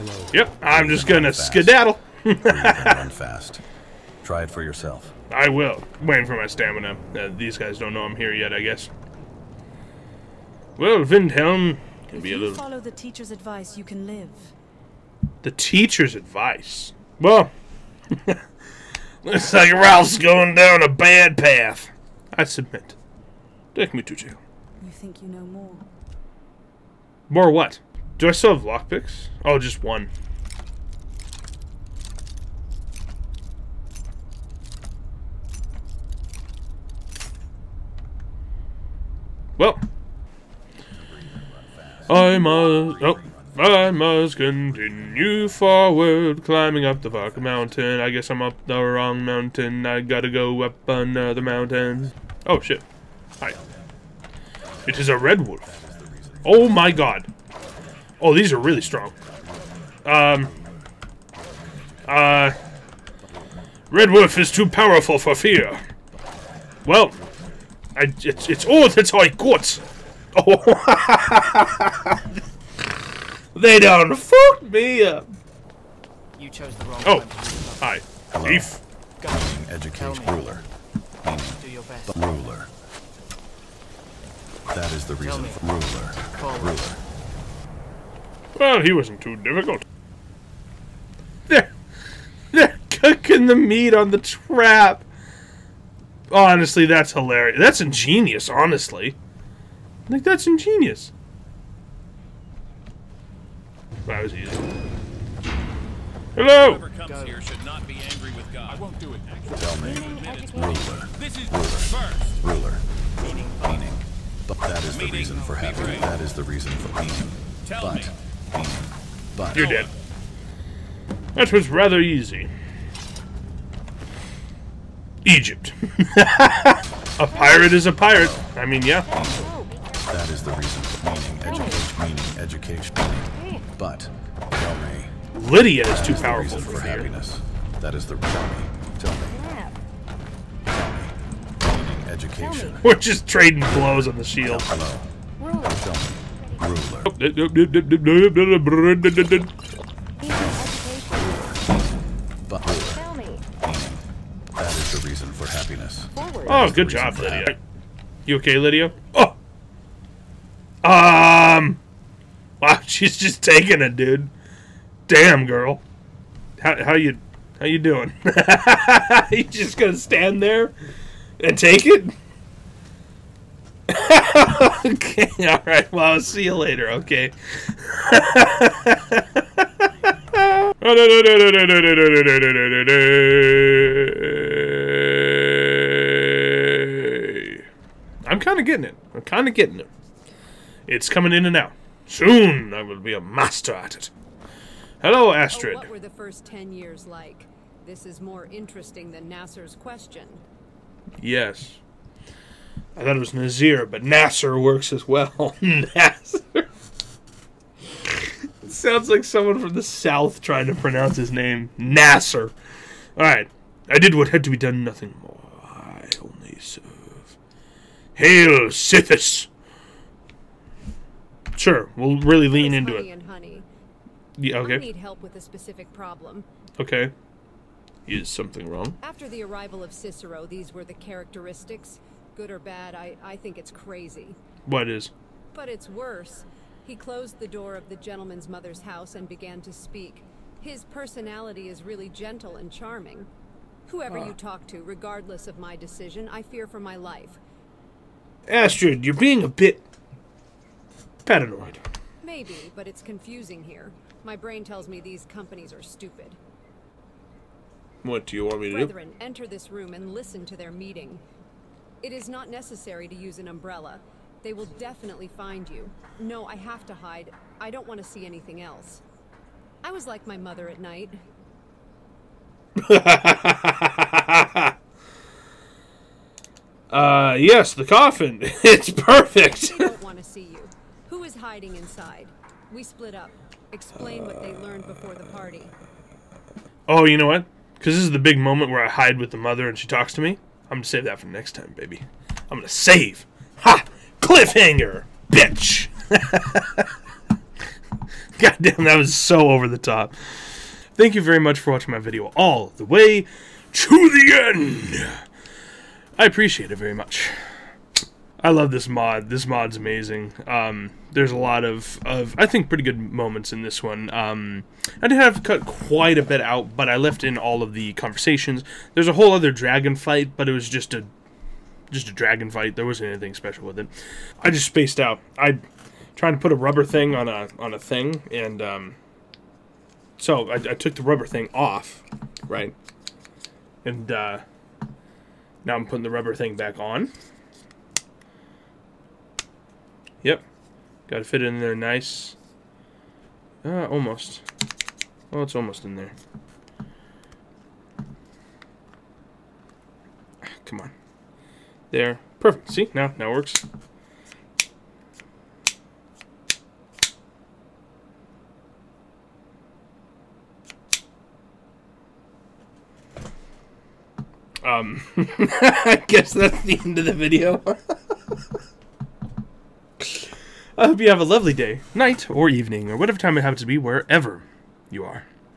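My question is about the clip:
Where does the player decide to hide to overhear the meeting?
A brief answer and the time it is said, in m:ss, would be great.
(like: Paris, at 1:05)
The coffin, at 4:37.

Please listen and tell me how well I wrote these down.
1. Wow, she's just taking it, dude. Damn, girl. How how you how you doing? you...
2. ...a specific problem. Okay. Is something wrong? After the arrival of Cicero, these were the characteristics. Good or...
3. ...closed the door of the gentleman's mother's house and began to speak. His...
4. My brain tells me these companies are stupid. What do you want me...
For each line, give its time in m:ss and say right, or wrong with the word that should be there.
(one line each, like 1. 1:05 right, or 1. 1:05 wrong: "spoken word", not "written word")
1. 2:42 right
2. 3:45 right
3. 3:56 right
4. 4:14 right.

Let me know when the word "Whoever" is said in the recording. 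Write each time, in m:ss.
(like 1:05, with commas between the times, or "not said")
1:46, 4:03.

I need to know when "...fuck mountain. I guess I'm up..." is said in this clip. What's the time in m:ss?
0:47.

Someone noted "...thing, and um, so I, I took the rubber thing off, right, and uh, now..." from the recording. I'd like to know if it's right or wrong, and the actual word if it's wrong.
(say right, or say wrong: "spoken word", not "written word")
right.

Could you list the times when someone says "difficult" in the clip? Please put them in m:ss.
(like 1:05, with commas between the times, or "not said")
1:29.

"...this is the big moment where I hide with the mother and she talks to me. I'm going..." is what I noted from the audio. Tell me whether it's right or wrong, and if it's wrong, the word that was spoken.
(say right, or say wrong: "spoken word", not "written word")
right.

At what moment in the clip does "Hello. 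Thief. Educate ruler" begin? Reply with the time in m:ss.
1:18.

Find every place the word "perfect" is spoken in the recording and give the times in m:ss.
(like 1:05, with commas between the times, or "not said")
4:38, 5:52.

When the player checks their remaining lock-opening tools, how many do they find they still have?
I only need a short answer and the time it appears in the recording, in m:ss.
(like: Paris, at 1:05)
1, at 0:29.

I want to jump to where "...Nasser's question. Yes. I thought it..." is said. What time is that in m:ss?
3:19.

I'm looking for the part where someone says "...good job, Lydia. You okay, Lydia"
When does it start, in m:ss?
2:36.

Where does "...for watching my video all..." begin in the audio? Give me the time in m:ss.
5:01.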